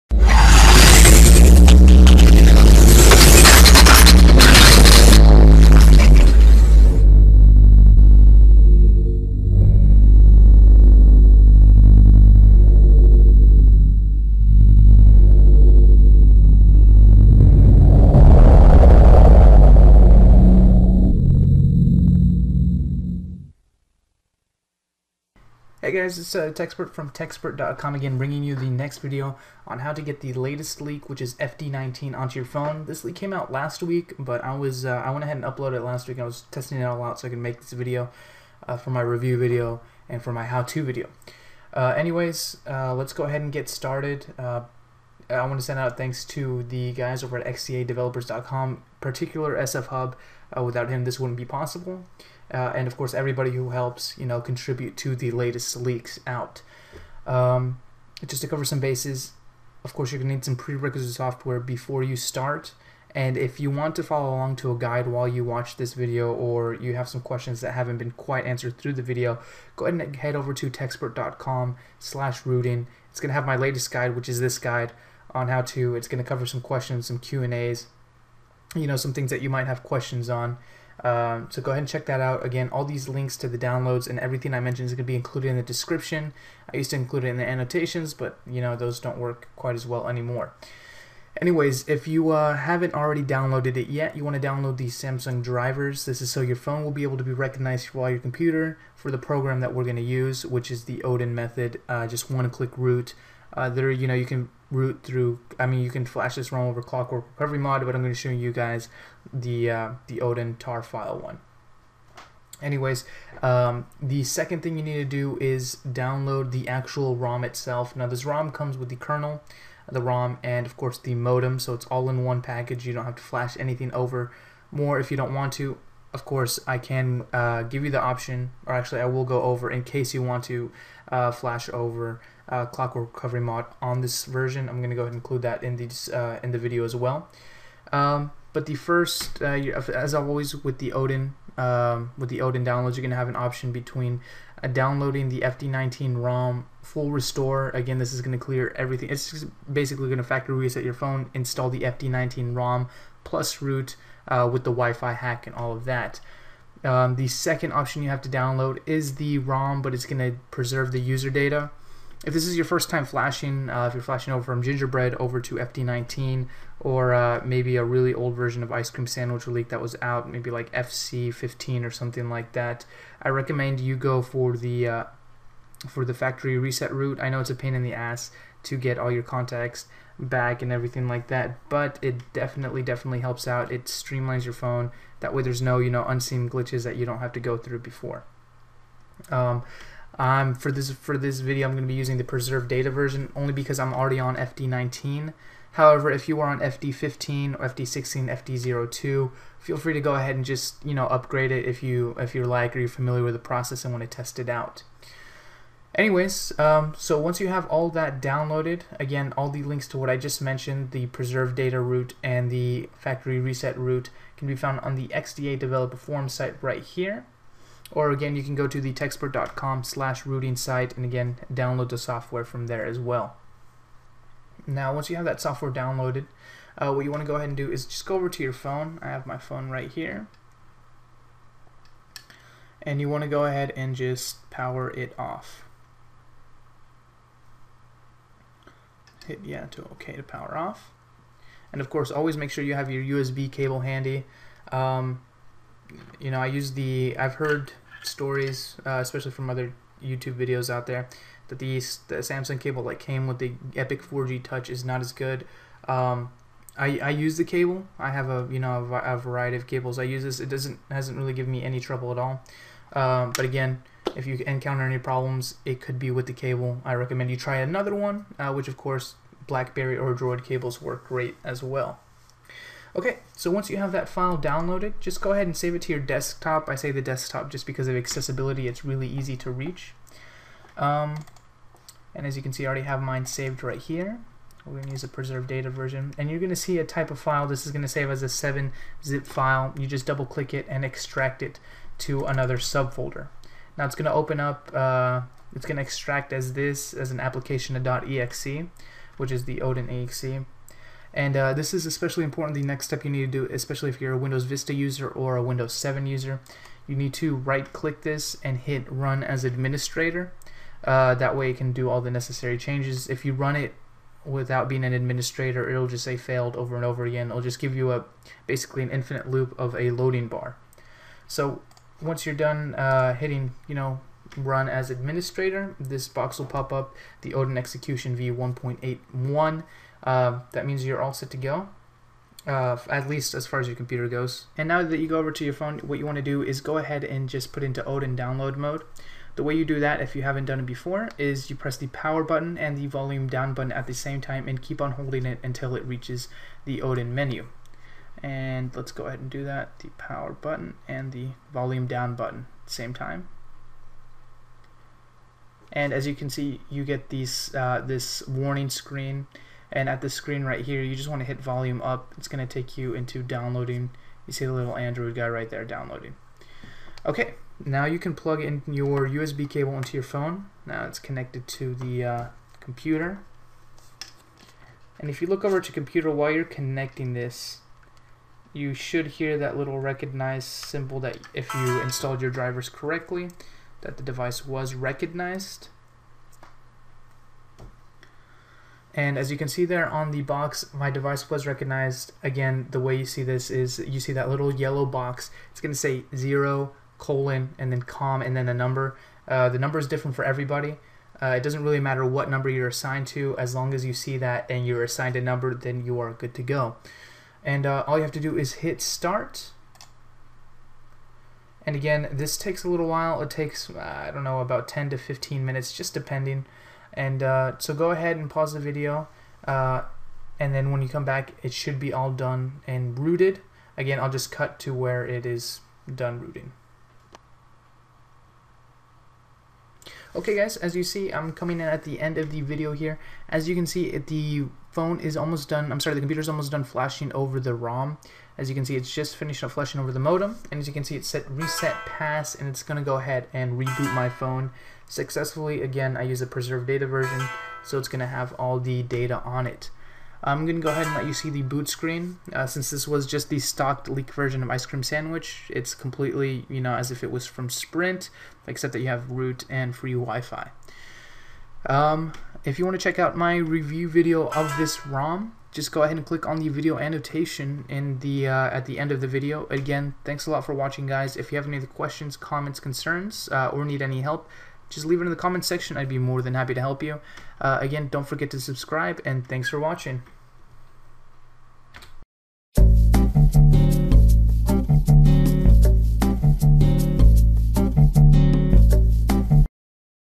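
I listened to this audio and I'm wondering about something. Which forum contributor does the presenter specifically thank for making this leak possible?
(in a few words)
SF Hub.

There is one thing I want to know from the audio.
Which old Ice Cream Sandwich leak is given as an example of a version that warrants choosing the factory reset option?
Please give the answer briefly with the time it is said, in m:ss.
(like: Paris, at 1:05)
FC15, at 2:50.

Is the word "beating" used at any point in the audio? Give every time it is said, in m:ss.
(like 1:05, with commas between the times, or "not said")
not said.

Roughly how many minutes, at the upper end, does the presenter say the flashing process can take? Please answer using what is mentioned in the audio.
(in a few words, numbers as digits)
15.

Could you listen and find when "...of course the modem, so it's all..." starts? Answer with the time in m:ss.
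2:00.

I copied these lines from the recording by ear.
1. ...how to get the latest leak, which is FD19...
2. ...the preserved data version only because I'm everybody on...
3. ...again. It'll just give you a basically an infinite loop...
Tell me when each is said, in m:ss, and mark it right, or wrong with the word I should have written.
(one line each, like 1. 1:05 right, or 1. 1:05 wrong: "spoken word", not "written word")
1. 0:29 right
2. 3:12 wrong: "already", not "everybody"
3. 5:17 right.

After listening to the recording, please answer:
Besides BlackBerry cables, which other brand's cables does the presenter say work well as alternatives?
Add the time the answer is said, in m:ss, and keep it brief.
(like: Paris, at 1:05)
Droid, at 4:30.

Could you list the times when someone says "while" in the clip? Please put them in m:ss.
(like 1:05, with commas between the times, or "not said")
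1:05, 1:37, 6:16, 6:52.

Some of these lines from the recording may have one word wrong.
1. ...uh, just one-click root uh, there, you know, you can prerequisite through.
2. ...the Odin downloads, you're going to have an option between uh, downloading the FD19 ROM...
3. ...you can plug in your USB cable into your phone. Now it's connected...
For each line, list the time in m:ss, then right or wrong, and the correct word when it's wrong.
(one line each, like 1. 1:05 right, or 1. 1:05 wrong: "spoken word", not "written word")
1. 1:41 wrong: "route", not "prerequisite"
2. 2:22 right
3. 6:07 right.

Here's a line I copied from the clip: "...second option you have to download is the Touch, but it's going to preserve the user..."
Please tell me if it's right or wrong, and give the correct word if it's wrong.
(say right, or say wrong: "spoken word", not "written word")
wrong: "ROM", not "Touch".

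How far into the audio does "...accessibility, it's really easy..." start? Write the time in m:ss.
4:37.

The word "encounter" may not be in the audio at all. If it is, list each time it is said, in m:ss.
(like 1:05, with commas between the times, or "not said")
4:24.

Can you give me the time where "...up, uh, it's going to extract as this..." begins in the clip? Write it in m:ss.
4:54.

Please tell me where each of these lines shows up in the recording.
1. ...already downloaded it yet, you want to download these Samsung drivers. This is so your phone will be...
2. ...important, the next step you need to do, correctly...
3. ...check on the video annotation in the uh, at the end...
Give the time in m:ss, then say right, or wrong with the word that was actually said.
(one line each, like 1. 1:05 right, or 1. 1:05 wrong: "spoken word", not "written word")
1. 1:32 right
2. 5:02 wrong: "especially", not "correctly"
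3. 7:46 wrong: "click", not "check".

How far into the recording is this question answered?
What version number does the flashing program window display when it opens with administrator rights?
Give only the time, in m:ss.
5:28.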